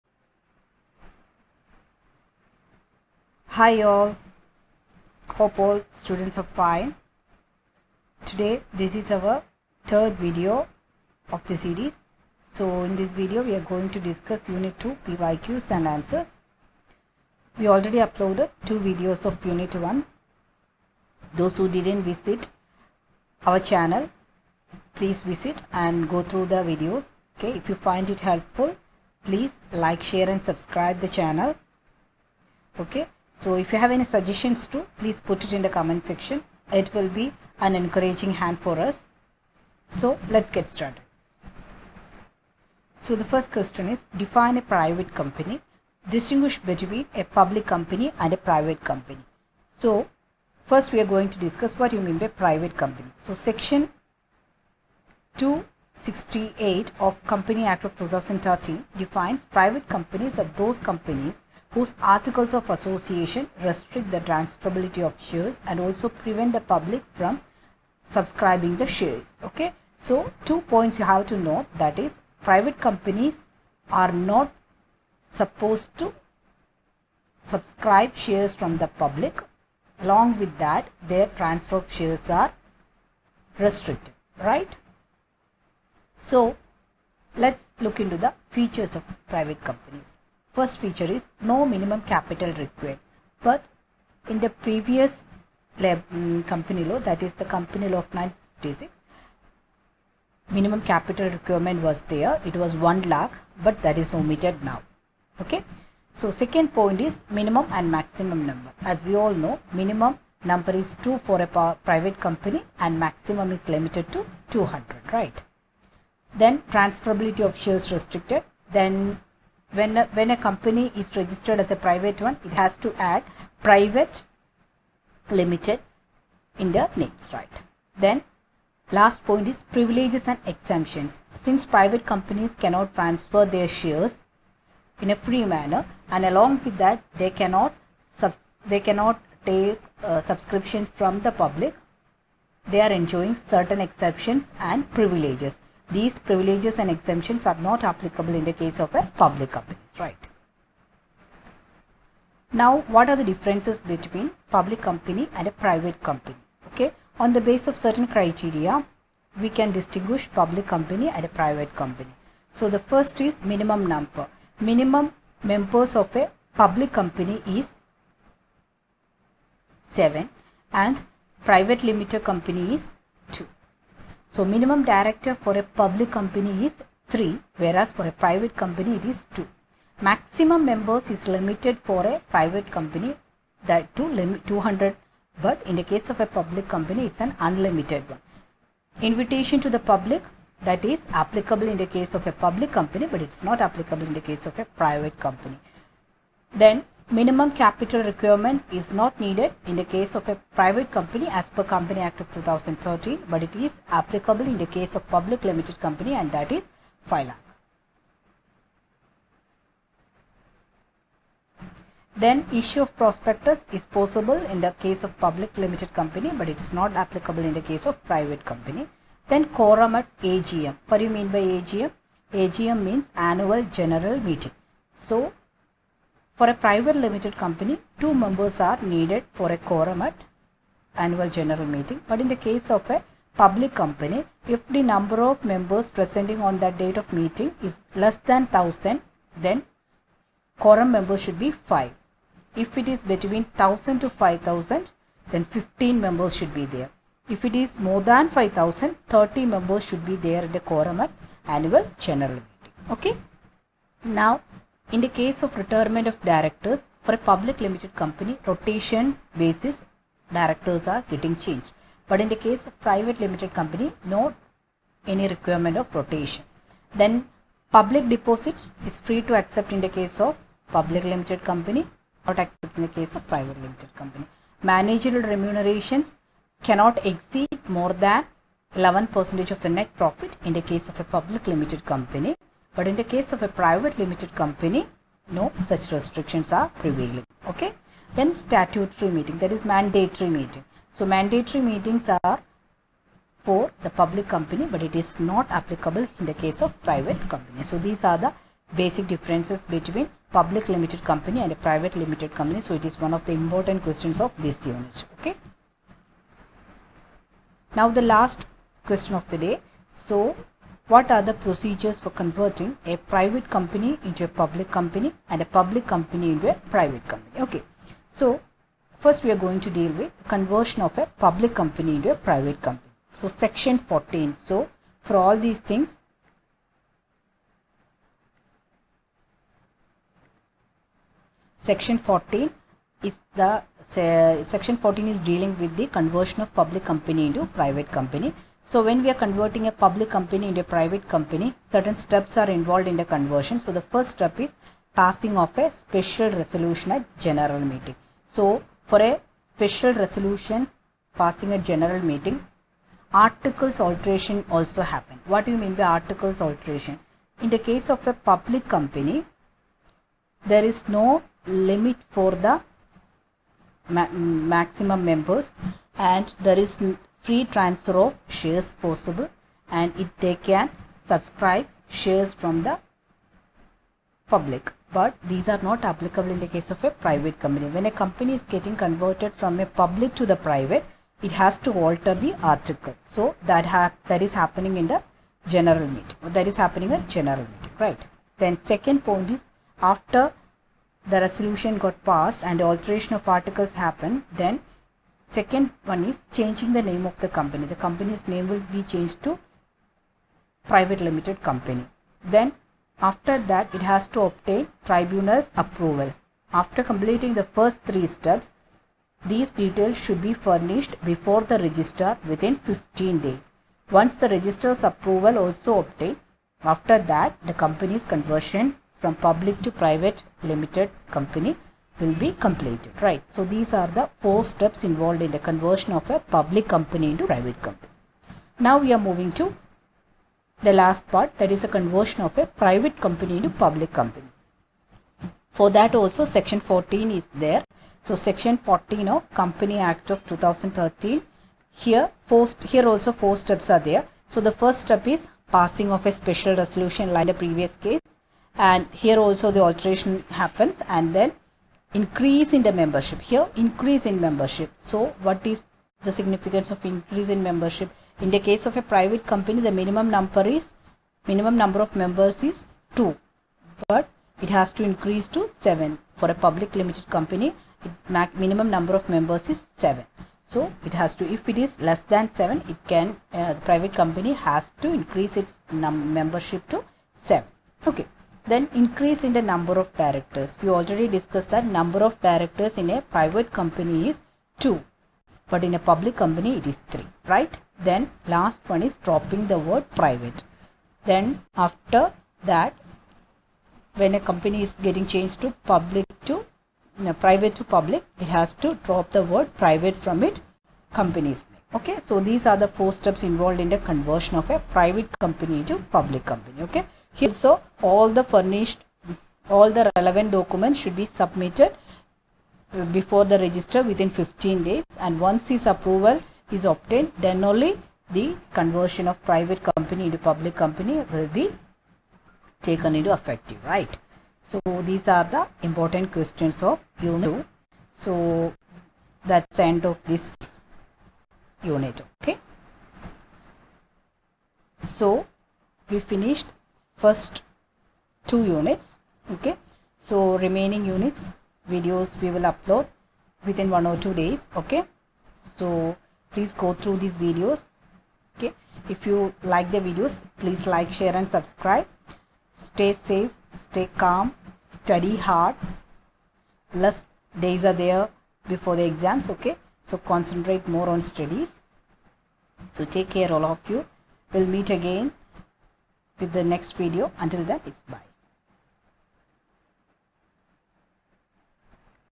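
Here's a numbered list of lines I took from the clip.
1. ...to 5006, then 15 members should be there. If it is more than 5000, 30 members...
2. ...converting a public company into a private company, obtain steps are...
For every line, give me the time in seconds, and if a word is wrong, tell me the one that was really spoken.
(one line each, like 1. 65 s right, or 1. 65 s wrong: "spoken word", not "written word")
1. 243 s wrong: "5000", not "5006"
2. 339 s wrong: "certain", not "obtain".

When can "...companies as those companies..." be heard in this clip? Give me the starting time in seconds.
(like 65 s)
59 s.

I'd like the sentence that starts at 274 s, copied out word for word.
Managerial remunerations cannot exceed more than 11 percentage of the net profit in the case of a public limited company.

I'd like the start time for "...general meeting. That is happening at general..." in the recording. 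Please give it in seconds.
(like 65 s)
385 s.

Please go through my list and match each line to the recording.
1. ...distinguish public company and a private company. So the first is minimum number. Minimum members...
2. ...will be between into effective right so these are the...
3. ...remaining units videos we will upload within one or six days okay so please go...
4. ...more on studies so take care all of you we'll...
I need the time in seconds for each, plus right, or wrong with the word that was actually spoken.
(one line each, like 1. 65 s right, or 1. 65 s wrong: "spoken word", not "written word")
1. 159 s right
2. 521 s wrong: "taken", not "between"
3. 540 s wrong: "two", not "six"
4. 560 s right.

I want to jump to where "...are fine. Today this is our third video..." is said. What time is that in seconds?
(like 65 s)
6 s.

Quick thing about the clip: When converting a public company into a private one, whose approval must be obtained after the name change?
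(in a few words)
Tribunal's.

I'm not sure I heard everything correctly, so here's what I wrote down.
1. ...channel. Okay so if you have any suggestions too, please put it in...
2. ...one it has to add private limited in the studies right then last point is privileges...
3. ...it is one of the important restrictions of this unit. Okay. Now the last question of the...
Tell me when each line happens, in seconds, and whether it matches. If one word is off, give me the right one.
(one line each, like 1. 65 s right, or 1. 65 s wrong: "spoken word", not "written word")
1. 31 s right
2. 122 s wrong: "names", not "studies"
3. 302 s wrong: "questions", not "restrictions".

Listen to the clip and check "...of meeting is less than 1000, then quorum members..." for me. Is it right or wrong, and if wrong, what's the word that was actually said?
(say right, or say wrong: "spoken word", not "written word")
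right.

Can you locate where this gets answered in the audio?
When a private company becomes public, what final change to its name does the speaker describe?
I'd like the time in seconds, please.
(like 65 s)
489 s.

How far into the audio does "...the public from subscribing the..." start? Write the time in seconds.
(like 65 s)
66 s.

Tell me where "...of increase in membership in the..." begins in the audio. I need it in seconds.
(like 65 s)
456 s.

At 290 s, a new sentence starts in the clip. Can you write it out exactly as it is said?
So mandatory meetings are for the public company but it is not applicable in the case of private company.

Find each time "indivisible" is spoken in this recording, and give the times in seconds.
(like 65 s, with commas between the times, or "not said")
not said.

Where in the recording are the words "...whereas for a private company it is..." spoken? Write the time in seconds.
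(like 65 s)
177 s.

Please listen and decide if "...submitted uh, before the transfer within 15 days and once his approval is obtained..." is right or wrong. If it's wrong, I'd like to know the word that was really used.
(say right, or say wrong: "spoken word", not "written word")
wrong: "register", not "transfer".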